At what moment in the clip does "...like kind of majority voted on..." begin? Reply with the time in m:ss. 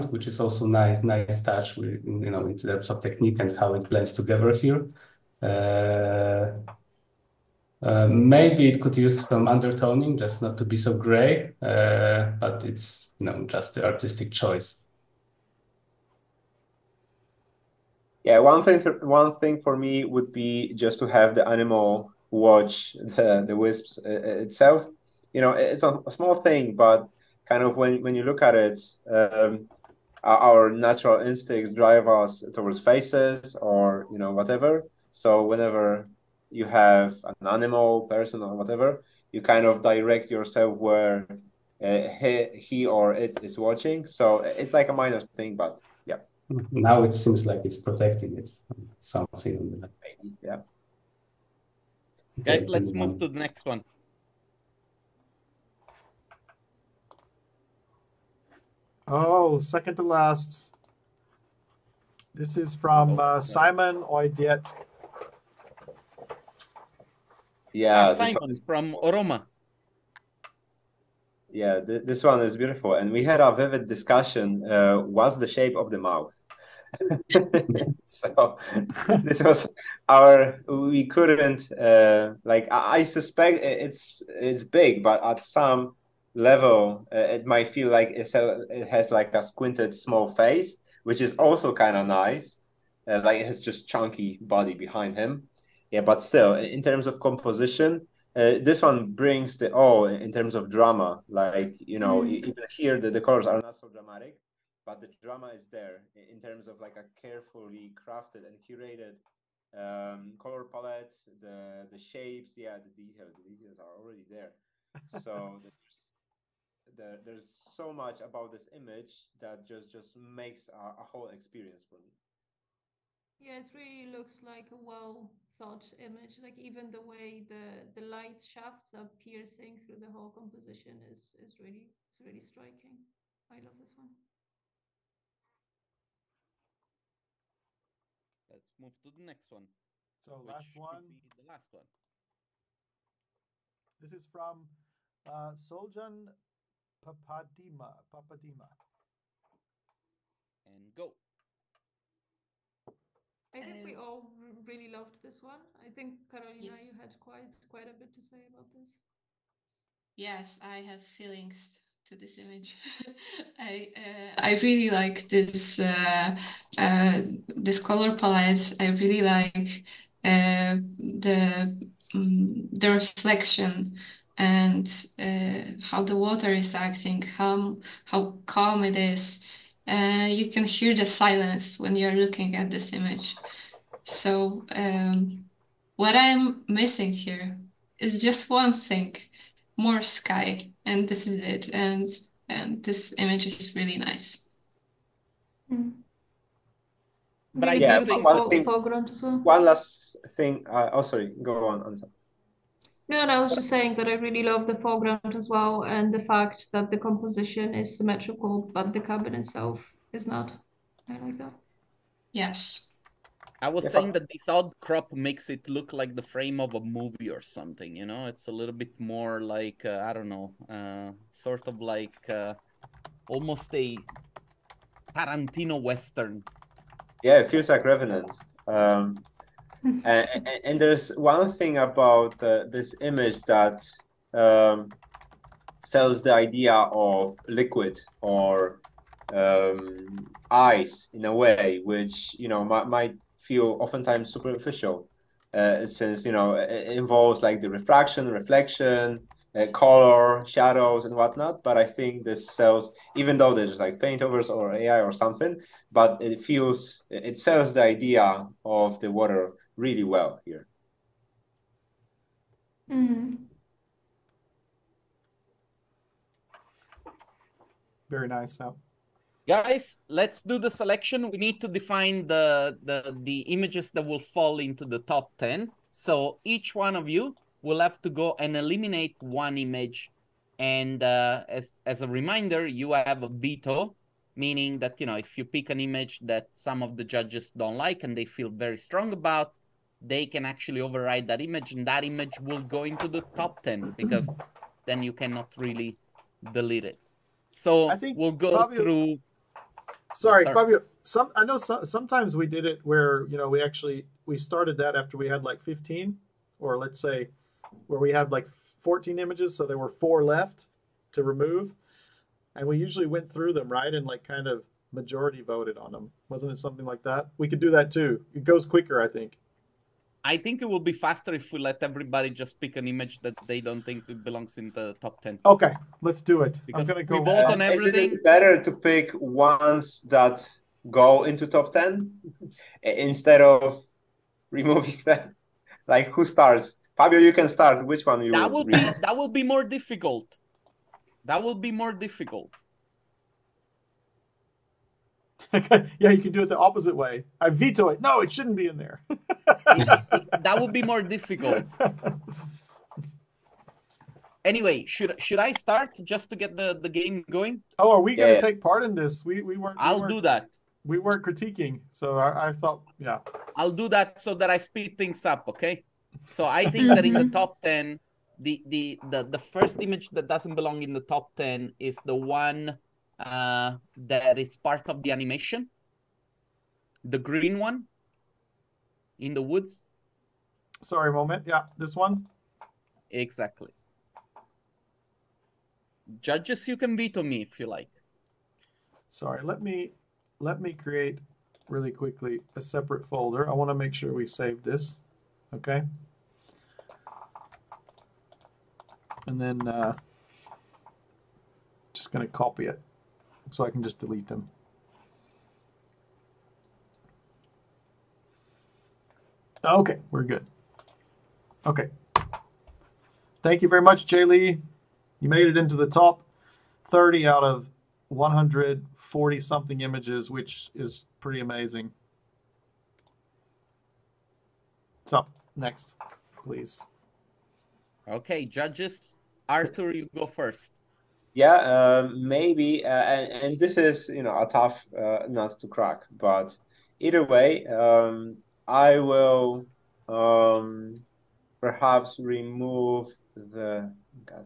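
5:14.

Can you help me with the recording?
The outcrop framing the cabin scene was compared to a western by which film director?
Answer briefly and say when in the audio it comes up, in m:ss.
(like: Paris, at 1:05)
Tarantino, at 3:45.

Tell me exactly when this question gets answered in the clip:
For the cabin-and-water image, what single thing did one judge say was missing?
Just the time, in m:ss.
3:09.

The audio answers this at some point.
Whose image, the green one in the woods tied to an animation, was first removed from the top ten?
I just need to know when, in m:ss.
6:54.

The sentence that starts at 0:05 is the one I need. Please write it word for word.
Uh, uh, maybe it could use some undertoning, just not to be so gray, but it's you know just the artistic choice.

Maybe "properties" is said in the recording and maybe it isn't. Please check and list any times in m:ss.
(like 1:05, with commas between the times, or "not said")
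not said.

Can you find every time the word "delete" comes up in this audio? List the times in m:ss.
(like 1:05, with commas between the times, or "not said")
4:56, 6:43.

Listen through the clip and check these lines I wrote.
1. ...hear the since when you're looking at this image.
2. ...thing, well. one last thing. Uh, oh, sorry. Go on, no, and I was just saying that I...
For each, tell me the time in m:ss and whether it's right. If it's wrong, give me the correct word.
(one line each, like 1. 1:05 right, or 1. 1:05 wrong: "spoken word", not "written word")
1. 3:00 wrong: "silence", not "since"
2. 3:18 right.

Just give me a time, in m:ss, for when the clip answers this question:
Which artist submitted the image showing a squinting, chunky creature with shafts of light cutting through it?
1:03.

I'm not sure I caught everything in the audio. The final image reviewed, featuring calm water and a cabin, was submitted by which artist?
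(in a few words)
Soljan Papadima.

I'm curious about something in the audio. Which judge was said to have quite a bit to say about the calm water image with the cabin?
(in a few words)
Karolina.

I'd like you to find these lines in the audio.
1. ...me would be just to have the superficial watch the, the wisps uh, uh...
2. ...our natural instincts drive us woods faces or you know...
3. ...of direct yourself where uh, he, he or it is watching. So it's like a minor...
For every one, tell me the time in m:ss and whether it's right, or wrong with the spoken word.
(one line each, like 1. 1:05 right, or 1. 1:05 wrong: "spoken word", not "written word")
1. 0:19 wrong: "animal", not "superficial"
2. 0:30 wrong: "towards", not "woods"
3. 0:39 right.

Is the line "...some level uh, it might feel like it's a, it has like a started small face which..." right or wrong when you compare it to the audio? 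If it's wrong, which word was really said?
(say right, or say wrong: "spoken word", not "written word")
wrong: "squinted", not "started".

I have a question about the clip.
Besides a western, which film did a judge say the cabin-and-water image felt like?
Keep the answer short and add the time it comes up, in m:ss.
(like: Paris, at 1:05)
Revenant, at 3:47.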